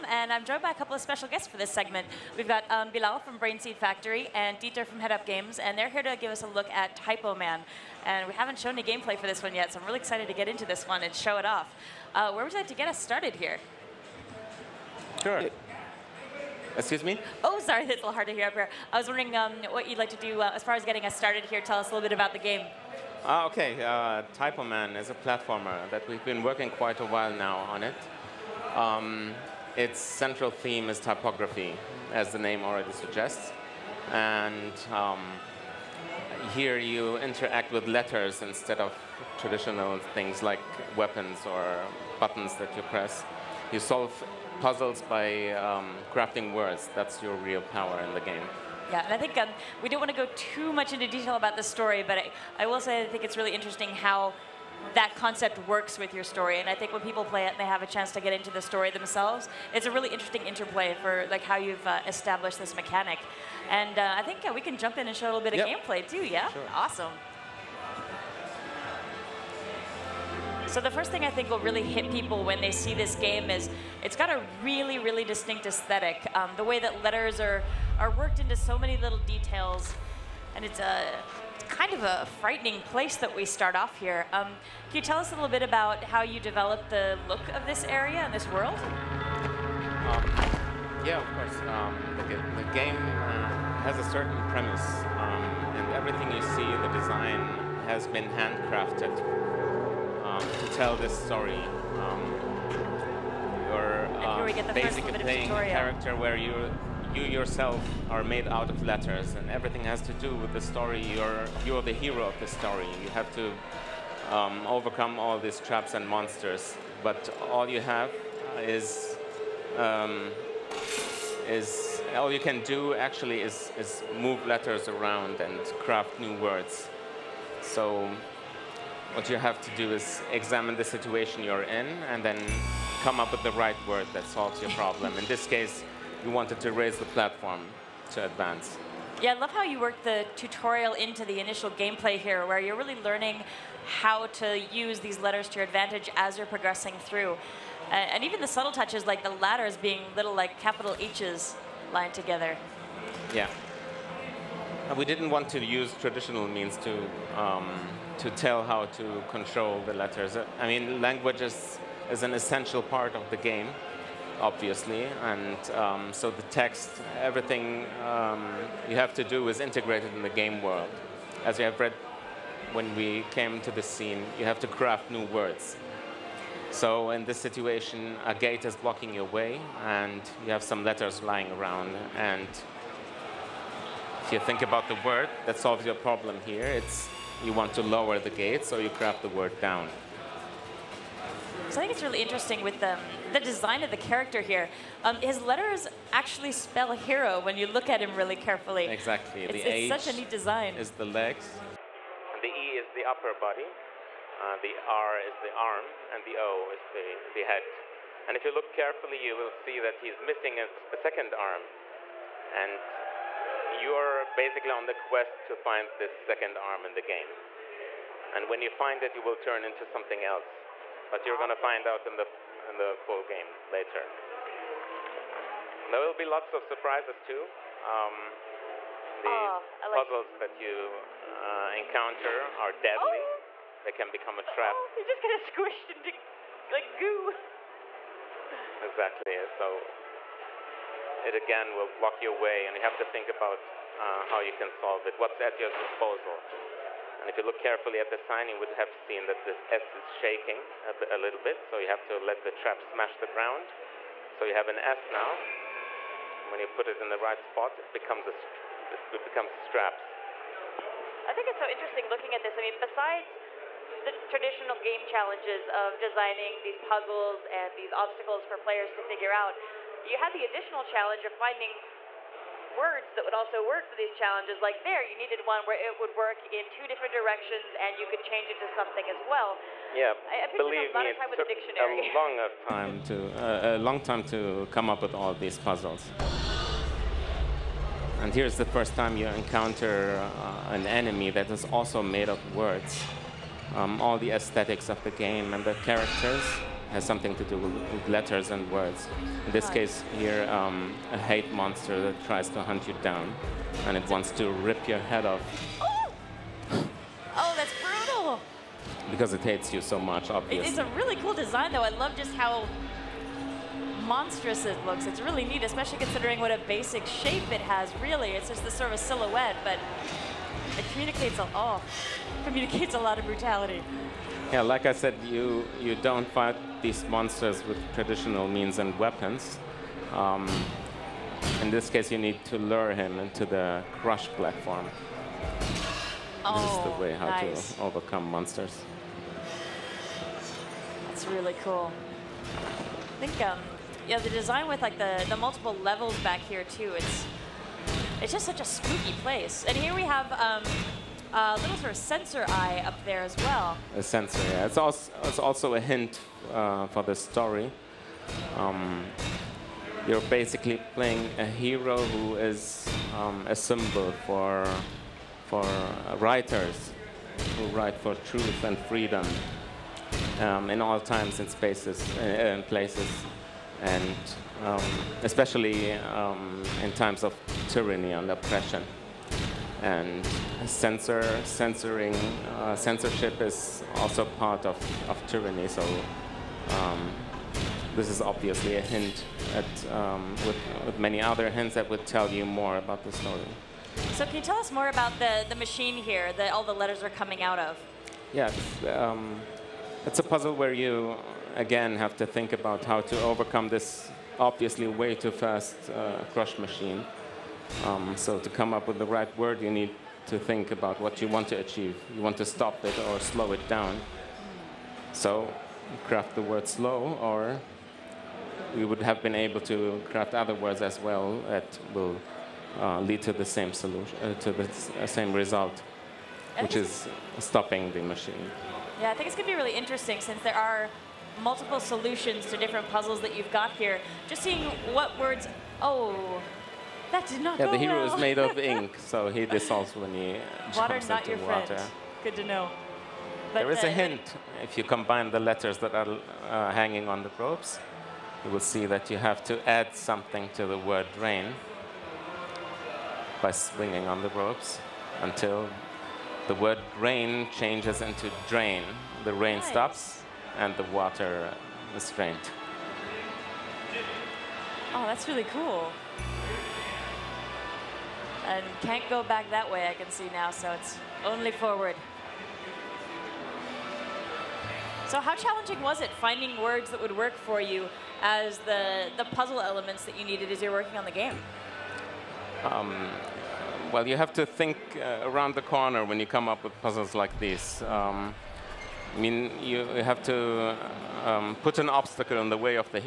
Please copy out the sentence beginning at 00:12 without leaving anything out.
Uh, where would you like to get us started here?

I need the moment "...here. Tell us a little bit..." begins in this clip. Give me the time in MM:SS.
00:21.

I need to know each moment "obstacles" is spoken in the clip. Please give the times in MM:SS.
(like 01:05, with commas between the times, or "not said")
04:27, 08:11.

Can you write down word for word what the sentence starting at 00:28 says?
Um, its central theme is typography, as the name already suggests.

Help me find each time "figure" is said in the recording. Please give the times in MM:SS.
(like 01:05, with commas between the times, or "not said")
04:29.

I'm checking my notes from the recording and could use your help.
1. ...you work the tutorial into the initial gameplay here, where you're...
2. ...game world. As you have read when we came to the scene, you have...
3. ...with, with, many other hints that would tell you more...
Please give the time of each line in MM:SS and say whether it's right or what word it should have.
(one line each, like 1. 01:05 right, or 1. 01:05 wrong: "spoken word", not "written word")
1. 02:19 right
2. 02:50 right
3. 06:30 right.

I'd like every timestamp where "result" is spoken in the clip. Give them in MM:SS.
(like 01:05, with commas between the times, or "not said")
07:05.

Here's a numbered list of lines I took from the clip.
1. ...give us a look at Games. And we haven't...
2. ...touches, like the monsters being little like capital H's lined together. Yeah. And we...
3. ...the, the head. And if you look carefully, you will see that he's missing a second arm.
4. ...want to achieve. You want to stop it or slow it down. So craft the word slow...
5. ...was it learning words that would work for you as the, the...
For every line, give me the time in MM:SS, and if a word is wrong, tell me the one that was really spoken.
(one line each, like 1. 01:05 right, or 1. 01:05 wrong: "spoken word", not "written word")
1. 00:06 wrong: "Typoman", not "Games"
2. 02:28 wrong: "letters", not "monsters"
3. 03:26 right
4. 06:51 right
5. 07:55 wrong: "finding", not "learning".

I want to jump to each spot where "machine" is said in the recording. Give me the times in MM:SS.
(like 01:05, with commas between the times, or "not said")
06:35, 06:46, 07:08.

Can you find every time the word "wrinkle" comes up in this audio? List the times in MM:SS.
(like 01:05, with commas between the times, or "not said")
not said.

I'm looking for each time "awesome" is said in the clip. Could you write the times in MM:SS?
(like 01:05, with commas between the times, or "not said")
01:06, 03:41.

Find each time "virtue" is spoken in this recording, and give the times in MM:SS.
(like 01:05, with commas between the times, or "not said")
not said.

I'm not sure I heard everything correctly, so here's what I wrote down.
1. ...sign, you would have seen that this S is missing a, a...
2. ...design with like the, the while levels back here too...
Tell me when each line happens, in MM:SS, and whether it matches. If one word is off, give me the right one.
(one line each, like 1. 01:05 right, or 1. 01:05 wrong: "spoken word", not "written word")
1. 04:08 wrong: "shaking", not "missing"
2. 05:44 wrong: "multiple", not "while".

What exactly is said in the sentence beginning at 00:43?
You solve puzzles by um, crafting words.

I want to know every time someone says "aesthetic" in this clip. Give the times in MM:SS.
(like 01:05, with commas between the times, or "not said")
01:15, 04:54.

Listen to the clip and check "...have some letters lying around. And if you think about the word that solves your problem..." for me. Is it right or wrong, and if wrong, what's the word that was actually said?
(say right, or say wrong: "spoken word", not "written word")
right.